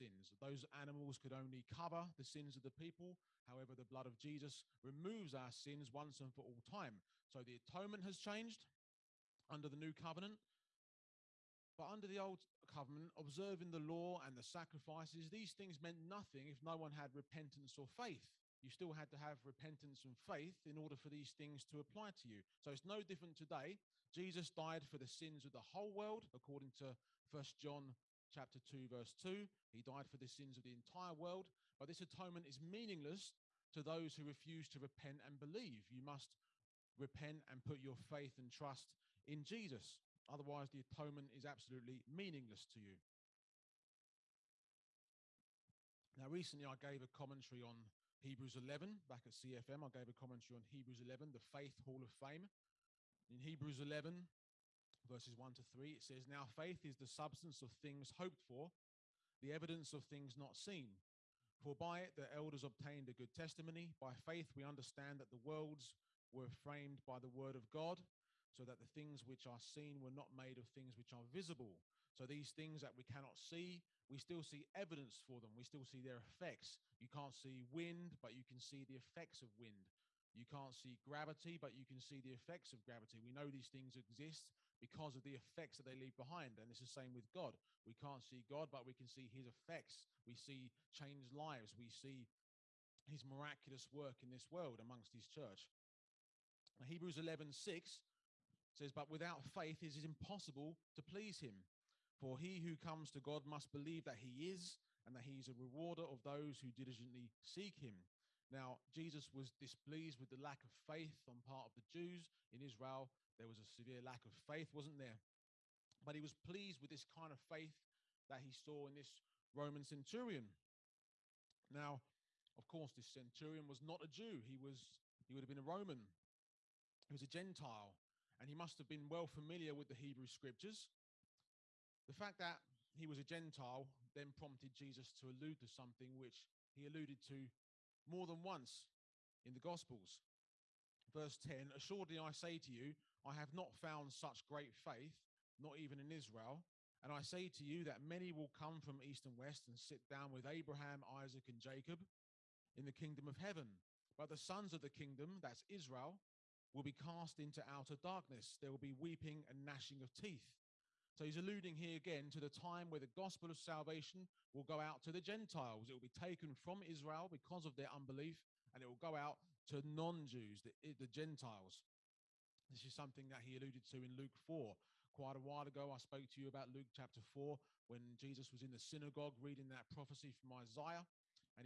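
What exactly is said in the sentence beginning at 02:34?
But the sons of the kingdom, that's Israel, will be cast into outer darkness.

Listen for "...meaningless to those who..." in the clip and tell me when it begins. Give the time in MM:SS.
00:32.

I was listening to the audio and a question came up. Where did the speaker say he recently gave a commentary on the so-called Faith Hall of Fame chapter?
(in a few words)
CFM.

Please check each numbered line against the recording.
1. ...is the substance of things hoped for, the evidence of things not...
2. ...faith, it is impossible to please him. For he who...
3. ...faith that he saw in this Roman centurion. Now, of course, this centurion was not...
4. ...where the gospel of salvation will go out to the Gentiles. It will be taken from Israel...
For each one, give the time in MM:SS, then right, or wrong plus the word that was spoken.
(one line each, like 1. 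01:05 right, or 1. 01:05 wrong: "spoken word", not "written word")
1. 00:56 right
2. 01:39 right
3. 01:57 right
4. 02:42 right.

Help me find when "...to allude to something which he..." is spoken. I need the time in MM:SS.
02:15.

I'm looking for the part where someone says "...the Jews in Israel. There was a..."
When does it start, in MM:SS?
01:51.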